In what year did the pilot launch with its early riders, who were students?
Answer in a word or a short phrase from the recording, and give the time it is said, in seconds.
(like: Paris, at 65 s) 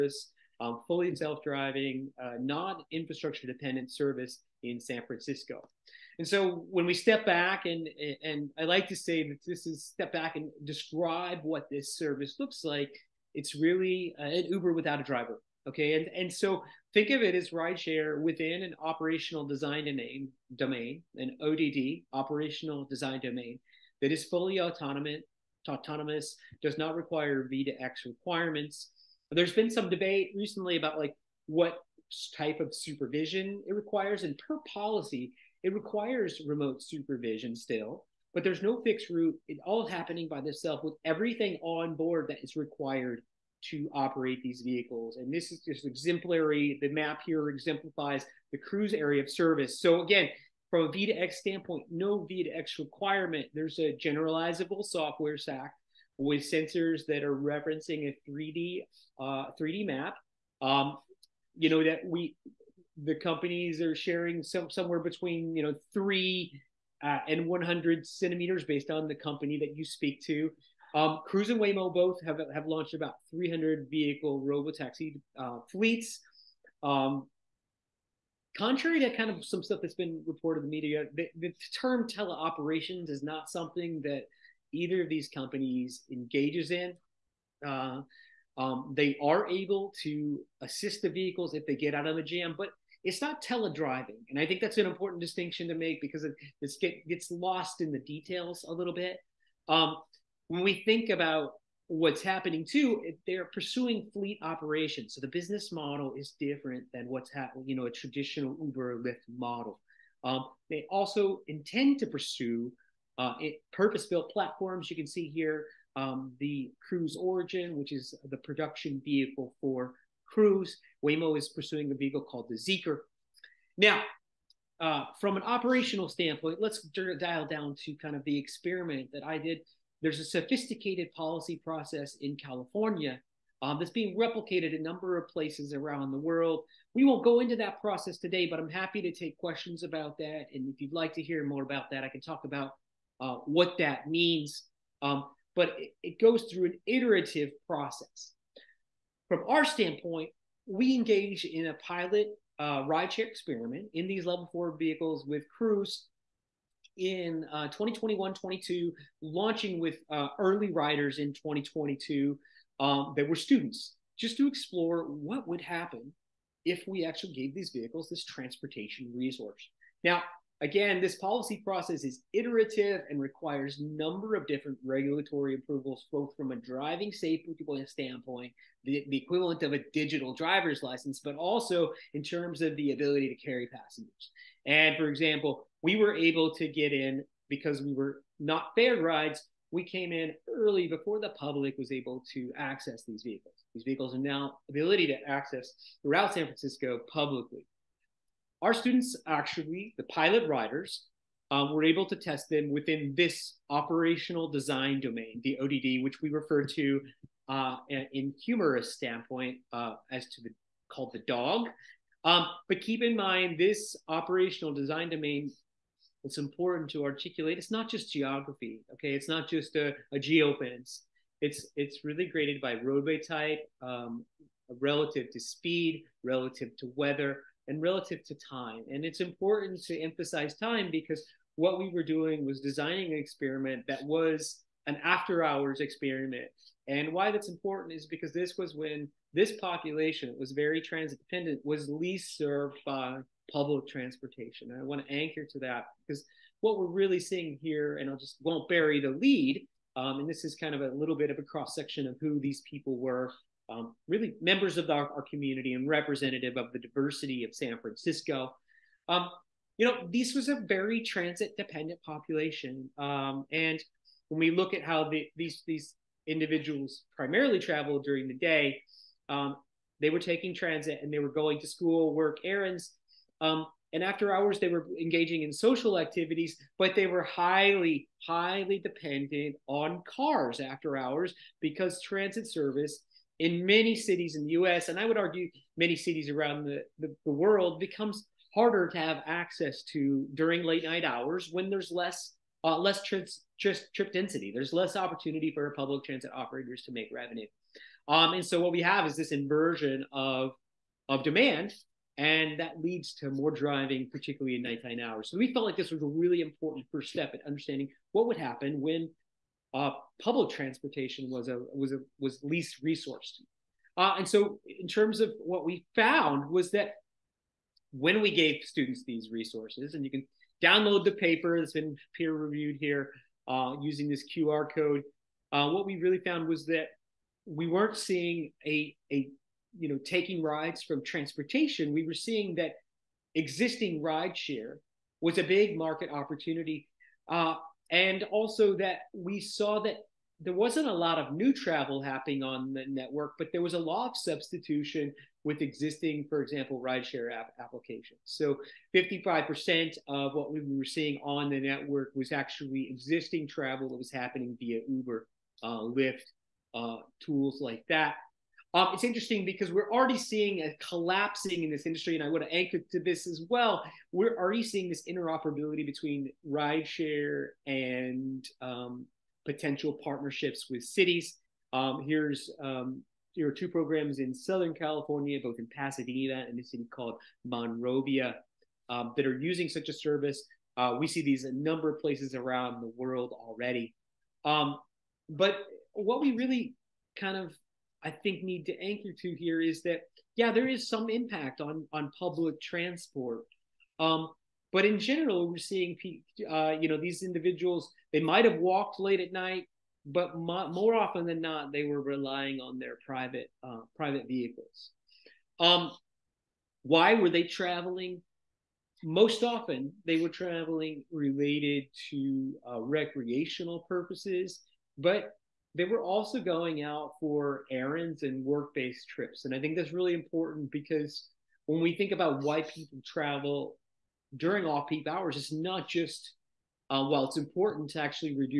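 2022, at 161 s.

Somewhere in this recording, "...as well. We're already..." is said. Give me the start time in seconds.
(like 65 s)
363 s.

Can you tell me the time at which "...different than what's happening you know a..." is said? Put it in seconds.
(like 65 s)
106 s.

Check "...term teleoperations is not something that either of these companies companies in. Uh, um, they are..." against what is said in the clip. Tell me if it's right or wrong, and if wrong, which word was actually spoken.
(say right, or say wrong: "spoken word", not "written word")
wrong: "engages", not "companies".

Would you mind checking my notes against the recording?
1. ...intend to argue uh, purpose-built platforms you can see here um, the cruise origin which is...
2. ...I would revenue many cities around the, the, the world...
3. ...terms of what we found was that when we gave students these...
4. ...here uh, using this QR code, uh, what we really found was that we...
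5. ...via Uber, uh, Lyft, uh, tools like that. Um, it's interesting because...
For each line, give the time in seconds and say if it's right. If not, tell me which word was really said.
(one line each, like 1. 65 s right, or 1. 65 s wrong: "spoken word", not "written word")
1. 111 s wrong: "pursue", not "argue"
2. 284 s wrong: "argue", not "revenue"
3. 314 s right
4. 322 s right
5. 354 s right.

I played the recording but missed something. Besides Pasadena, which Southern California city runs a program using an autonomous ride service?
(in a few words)
Monrovia.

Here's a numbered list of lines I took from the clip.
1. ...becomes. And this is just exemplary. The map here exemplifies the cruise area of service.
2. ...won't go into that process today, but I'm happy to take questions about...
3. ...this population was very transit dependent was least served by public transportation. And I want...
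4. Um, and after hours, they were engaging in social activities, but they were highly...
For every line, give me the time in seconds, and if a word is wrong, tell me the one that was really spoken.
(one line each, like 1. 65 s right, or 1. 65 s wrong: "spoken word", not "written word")
1. 44 s wrong: "vehicles", not "becomes"
2. 137 s right
3. 239 s right
4. 273 s right.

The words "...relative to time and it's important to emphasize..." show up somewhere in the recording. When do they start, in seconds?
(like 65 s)
227 s.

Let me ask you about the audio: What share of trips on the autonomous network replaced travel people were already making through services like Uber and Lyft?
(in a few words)
55%.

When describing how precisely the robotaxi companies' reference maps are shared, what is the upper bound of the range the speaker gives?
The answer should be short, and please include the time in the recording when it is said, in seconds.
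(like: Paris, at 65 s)
100 centimeters, at 67 s.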